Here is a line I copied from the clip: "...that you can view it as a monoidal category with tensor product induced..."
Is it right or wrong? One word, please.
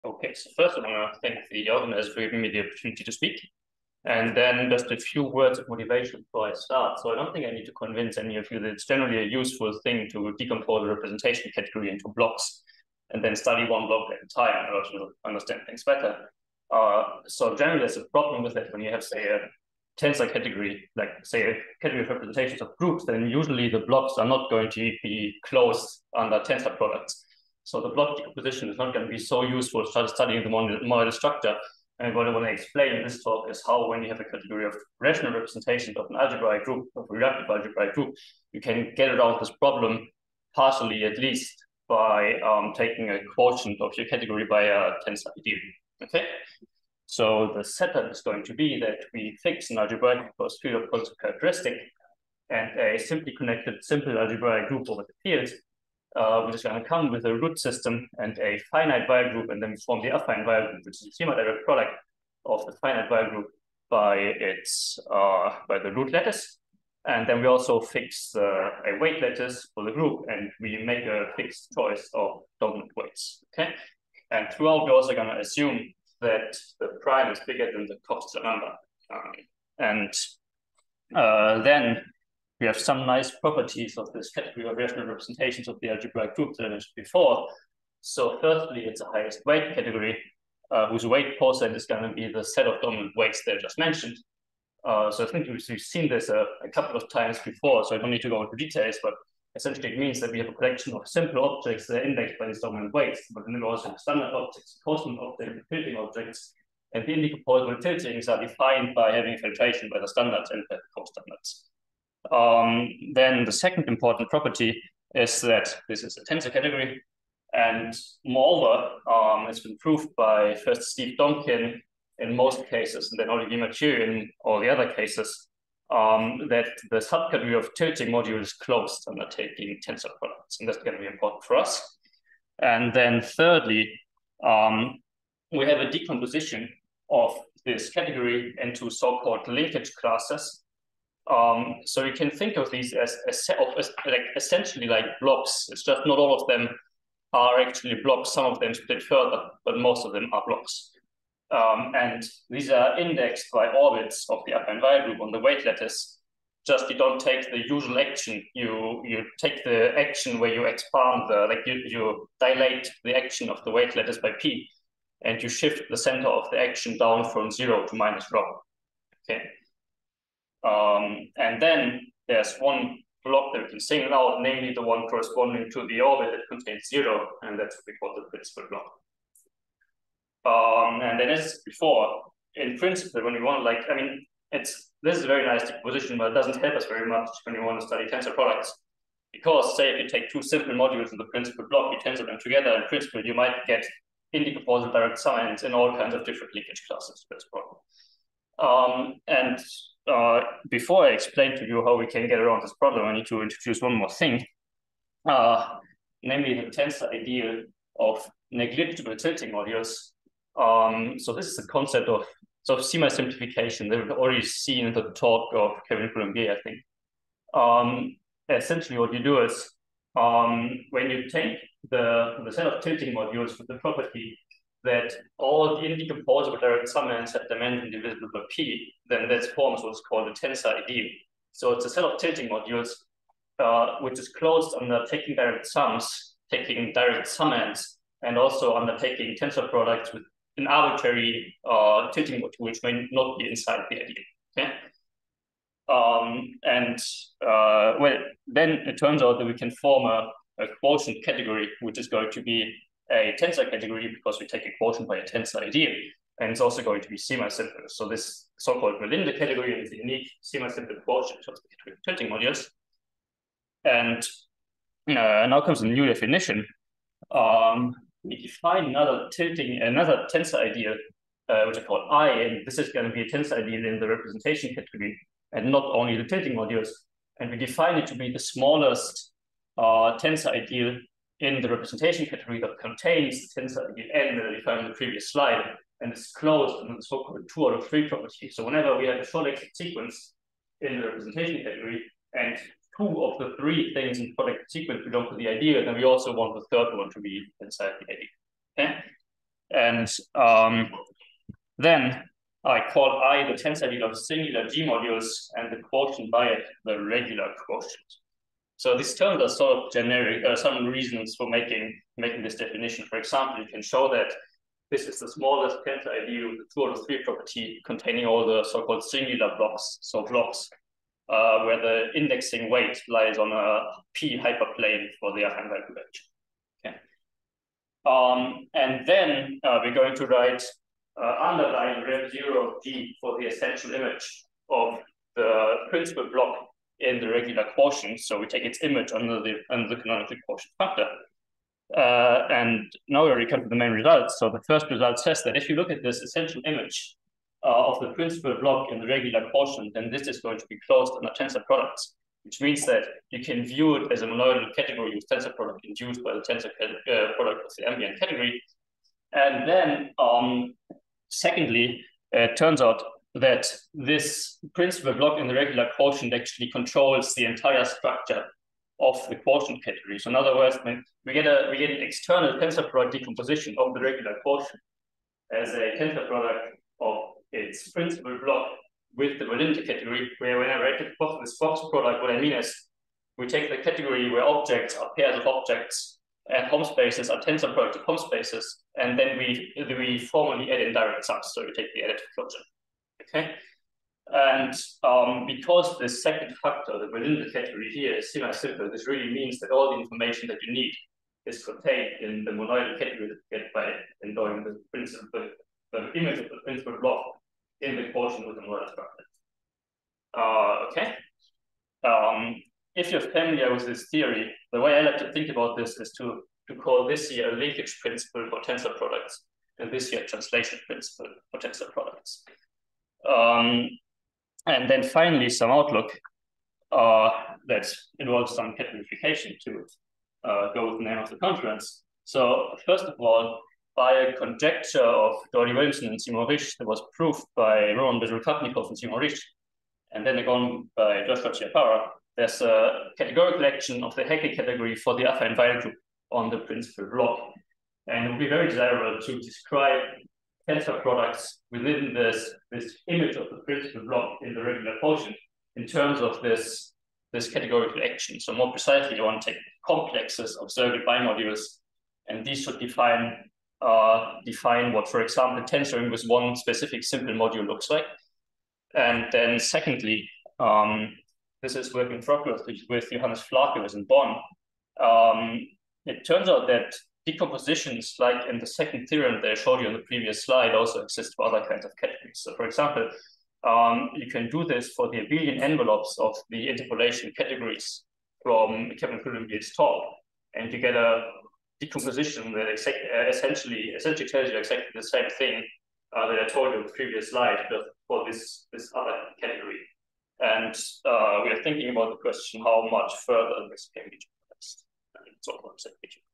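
right.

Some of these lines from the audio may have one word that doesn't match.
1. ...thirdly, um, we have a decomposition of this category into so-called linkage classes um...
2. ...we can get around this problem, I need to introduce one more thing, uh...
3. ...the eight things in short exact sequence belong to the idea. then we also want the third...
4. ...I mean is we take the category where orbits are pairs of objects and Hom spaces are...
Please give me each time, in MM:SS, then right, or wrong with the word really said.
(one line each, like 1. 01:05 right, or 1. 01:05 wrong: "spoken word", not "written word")
1. 02:13 right
2. 03:21 right
3. 04:53 wrong: "three", not "eight"
4. 06:22 wrong: "objects", not "orbits".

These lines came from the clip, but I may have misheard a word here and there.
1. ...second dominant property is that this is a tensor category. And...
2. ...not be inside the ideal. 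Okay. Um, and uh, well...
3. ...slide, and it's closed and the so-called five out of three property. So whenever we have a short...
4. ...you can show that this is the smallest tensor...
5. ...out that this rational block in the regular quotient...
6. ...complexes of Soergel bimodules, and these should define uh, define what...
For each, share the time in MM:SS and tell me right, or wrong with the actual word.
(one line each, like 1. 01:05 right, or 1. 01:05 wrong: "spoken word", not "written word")
1. 01:53 wrong: "important", not "dominant"
2. 04:03 right
3. 04:45 wrong: "two", not "five"
4. 05:13 right
5. 06:02 wrong: "principal", not "rational"
6. 07:39 right.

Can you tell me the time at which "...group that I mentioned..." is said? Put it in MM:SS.
01:26.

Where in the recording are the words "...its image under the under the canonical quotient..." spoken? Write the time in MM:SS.
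05:38.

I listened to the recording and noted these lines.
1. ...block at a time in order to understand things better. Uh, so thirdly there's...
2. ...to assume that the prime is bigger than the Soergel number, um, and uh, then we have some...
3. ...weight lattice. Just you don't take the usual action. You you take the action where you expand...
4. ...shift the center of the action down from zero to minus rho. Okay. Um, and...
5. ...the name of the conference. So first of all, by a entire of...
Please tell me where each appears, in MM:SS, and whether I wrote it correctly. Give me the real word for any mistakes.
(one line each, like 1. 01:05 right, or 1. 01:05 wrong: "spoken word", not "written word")
1. 00:13 wrong: "generally", not "thirdly"
2. 01:15 wrong: "Coxeter", not "Soergel"
3. 02:35 right
4. 02:45 right
5. 07:10 wrong: "conjecture", not "entire".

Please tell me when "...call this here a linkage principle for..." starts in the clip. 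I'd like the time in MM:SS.
06:56.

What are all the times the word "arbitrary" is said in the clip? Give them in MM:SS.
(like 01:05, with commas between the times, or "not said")
04:00.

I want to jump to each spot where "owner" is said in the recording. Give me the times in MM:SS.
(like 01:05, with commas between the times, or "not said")
not said.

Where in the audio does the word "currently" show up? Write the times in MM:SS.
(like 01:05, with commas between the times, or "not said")
not said.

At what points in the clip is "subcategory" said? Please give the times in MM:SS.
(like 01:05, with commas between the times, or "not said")
02:06.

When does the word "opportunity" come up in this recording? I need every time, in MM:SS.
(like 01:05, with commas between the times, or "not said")
00:02.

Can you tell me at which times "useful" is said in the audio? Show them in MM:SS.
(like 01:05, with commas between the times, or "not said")
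00:09, 00:29.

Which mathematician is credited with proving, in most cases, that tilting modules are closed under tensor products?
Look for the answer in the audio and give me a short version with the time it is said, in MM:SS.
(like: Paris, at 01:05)
Steve Donkin, at 02:00.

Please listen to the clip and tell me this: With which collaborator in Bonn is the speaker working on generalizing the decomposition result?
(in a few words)
Johannes Flakius.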